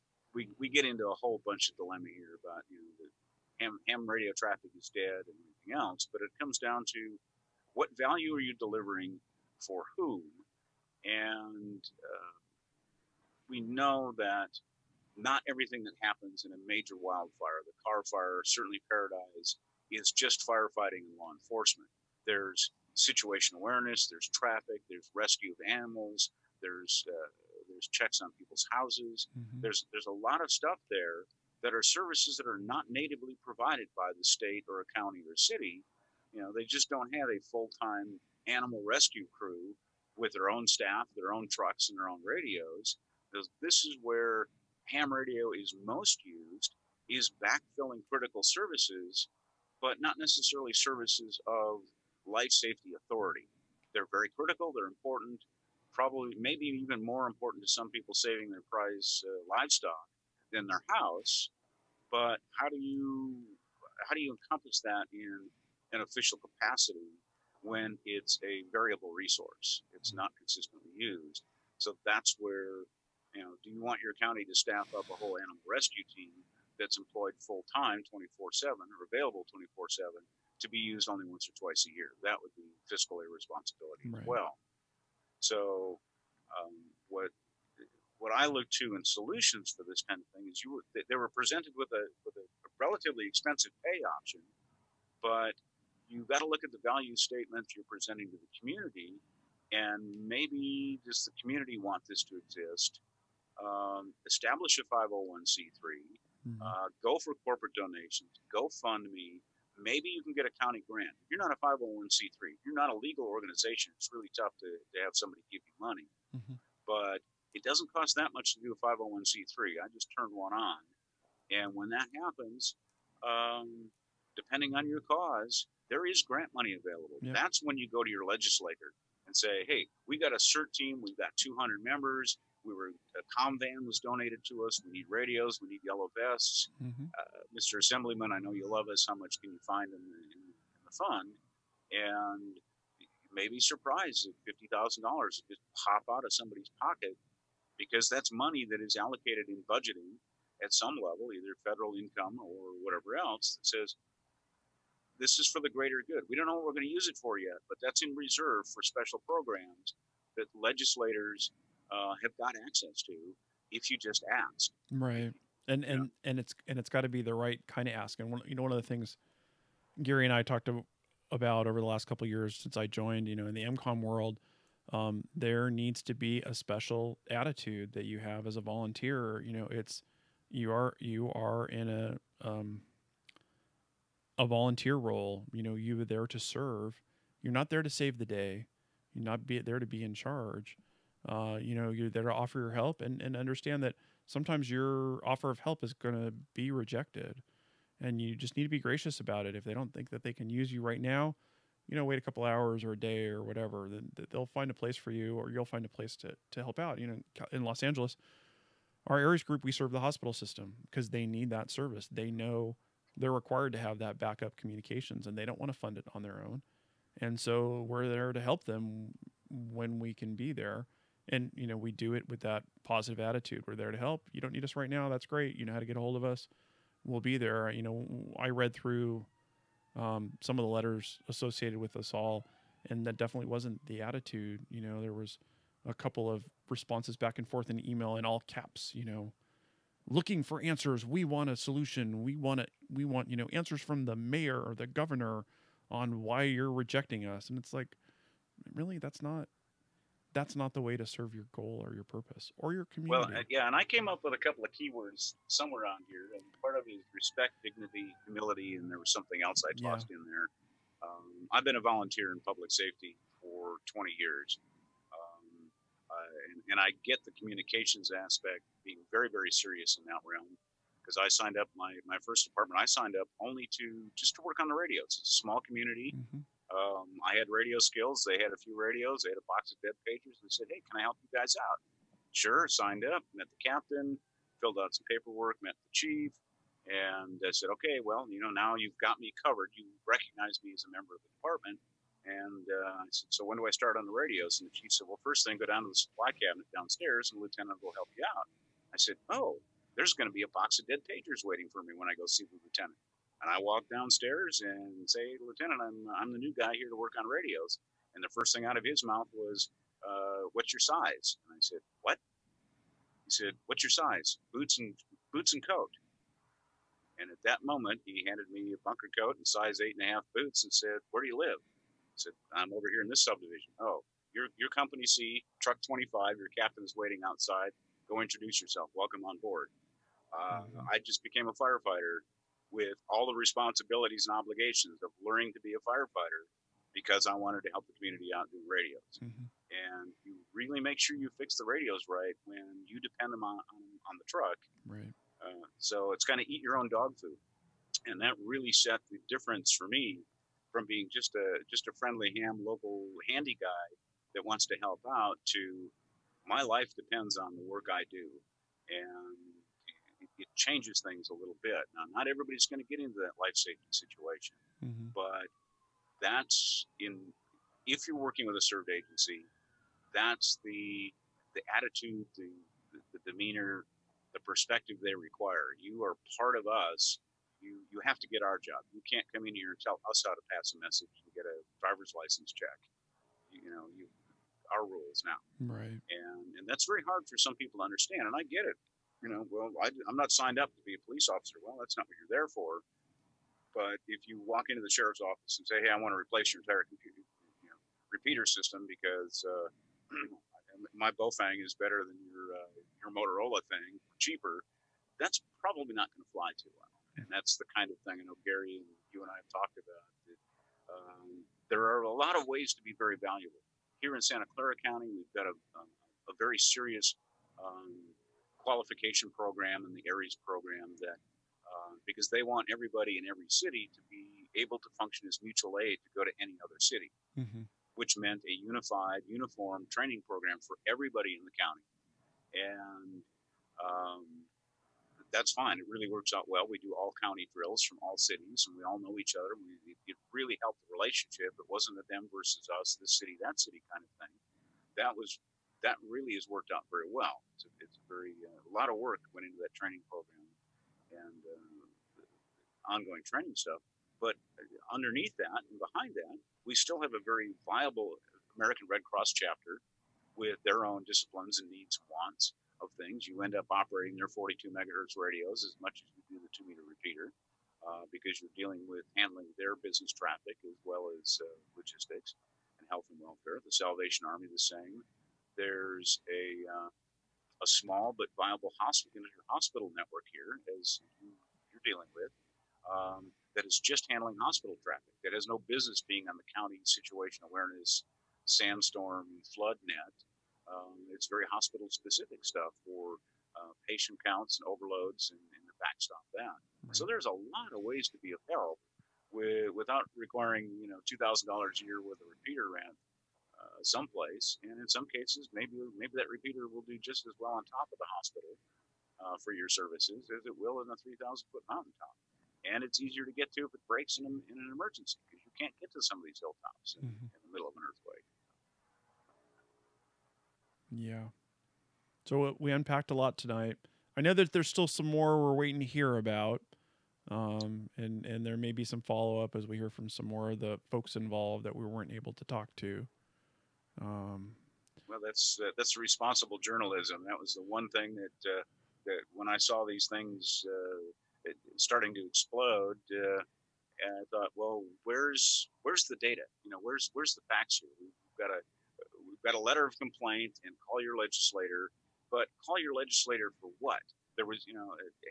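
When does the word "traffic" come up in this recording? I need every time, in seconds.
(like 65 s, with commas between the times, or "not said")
4 s, 24 s, 470 s, 484 s.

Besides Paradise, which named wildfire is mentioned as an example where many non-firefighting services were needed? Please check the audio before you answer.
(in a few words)
Carr fire.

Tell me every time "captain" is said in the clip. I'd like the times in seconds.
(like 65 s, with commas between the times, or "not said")
283 s, 326 s.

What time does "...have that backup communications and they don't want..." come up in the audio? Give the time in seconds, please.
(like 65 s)
213 s.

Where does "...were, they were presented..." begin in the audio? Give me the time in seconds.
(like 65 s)
90 s.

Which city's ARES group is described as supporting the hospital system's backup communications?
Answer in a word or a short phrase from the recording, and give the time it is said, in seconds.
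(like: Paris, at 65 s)
Los Angeles, at 207 s.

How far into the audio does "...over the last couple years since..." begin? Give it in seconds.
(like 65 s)
171 s.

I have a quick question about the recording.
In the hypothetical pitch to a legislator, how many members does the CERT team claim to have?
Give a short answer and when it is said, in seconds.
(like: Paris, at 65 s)
200, at 131 s.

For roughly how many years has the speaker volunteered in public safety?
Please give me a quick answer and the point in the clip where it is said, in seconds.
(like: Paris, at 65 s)
20 years, at 263 s.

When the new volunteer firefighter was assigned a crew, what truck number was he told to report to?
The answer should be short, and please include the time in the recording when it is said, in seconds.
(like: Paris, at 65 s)
25, at 325 s.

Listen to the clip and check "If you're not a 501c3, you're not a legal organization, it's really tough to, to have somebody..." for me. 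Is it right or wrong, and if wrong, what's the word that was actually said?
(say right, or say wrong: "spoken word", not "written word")
right.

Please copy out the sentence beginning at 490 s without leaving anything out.
Um, it's very hospital specific stuff for uh, patient counts and overloads and, and backstop that.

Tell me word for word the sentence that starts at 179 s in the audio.
You know, it's you are you are in a um, a volunteer role.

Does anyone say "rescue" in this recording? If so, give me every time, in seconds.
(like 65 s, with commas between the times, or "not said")
25 s, 38 s, 75 s.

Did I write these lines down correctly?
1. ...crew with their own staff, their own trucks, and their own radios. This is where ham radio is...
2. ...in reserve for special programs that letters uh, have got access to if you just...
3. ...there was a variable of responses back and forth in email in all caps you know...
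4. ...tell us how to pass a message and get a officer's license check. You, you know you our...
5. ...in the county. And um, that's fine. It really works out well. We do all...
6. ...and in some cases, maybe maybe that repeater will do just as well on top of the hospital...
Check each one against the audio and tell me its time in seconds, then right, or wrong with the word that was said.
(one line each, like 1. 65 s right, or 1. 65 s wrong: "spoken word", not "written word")
1. 39 s right
2. 158 s wrong: "legislators", not "letters"
3. 234 s wrong: "couple", not "variable"
4. 379 s wrong: "driver", not "officer"
5. 431 s right
6. 504 s right.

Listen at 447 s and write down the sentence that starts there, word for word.
It's a, it's a very uh, a lot of work went into that training program and uh, ongoing training stuff.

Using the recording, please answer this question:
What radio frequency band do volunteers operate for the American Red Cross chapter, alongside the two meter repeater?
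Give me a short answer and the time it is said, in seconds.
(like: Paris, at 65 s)
42 megahertz, at 464 s.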